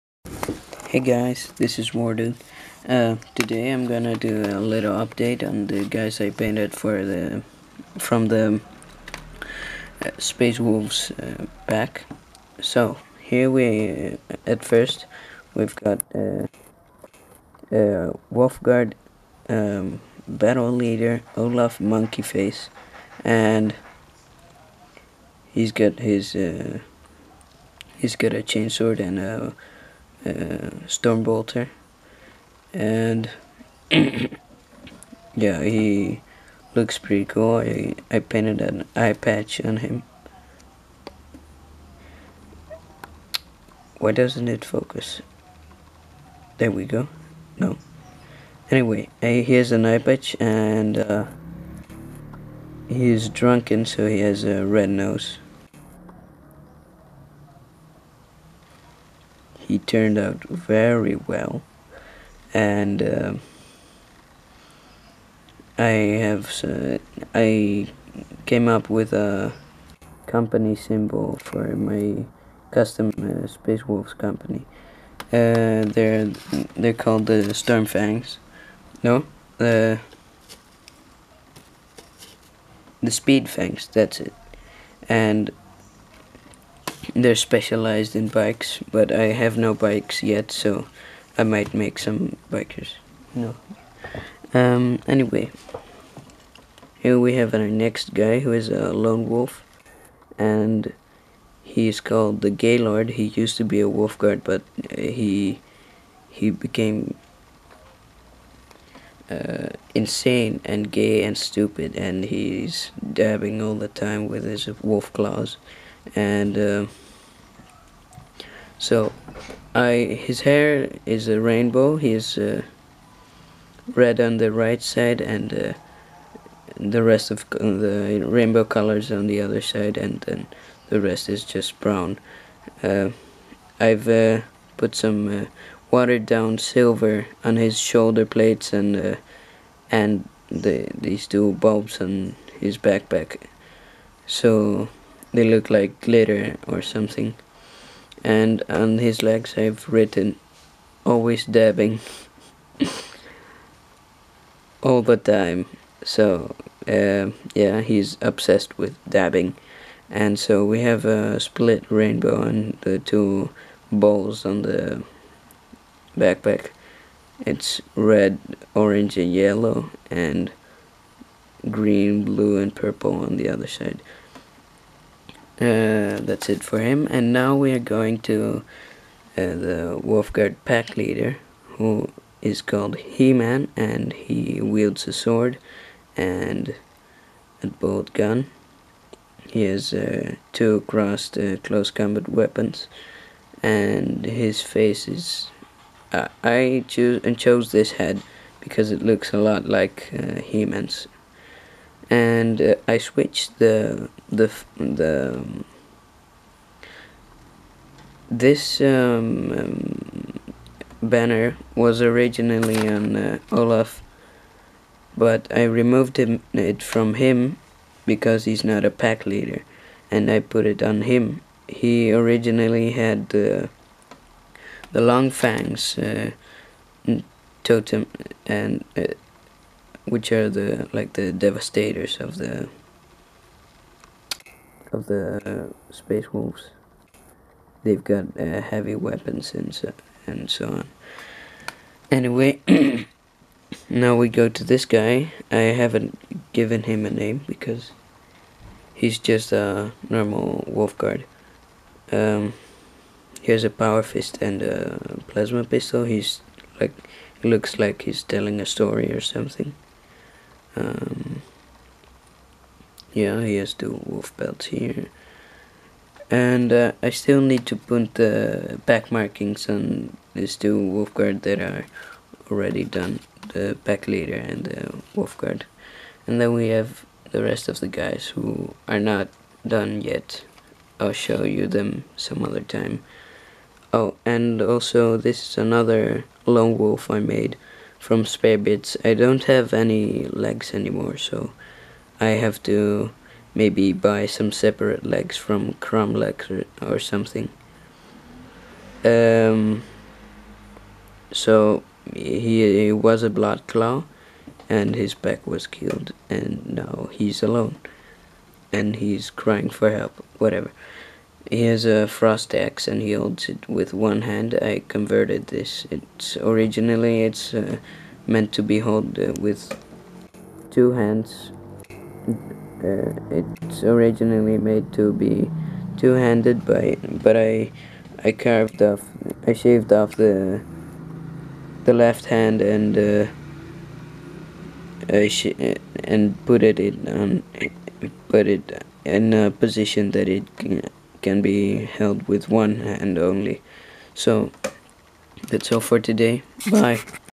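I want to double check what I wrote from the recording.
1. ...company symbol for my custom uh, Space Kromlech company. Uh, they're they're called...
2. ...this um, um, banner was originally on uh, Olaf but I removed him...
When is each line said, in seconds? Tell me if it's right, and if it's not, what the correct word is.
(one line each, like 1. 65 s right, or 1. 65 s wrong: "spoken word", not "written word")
1. 70 s wrong: "Wolves", not "Kromlech"
2. 208 s right.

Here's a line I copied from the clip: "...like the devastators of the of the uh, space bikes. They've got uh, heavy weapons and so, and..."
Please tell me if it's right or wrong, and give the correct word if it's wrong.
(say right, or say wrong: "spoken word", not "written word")
wrong: "wolves", not "bikes".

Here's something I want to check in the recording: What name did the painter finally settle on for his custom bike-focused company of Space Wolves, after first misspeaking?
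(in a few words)
Speed Fangs.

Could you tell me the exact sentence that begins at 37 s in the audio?
I, I painted an eye patch on him.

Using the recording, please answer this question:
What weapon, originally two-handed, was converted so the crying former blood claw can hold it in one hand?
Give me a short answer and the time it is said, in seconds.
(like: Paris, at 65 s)
frost axe, at 312 s.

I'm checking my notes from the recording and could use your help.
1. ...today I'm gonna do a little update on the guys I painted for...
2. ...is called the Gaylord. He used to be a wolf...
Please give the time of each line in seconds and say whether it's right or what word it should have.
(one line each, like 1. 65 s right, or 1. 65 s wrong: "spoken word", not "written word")
1. 3 s right
2. 101 s right.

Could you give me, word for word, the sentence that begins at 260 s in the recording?
Um, yeah, he has the wolf belt here.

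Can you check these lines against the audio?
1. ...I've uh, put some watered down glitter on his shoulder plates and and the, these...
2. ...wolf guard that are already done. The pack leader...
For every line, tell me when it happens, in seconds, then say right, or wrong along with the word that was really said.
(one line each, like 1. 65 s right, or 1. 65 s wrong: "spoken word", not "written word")
1. 133 s wrong: "silver", not "glitter"
2. 270 s right.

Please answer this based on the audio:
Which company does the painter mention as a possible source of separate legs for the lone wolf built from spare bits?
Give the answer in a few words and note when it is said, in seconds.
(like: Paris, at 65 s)
Kromlech, at 295 s.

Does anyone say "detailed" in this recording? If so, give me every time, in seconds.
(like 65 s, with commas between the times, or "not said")
not said.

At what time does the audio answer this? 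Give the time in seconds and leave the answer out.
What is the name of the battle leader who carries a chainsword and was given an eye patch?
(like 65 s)
21 s.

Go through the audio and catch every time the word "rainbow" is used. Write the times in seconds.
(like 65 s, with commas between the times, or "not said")
121 s, 128 s, 161 s.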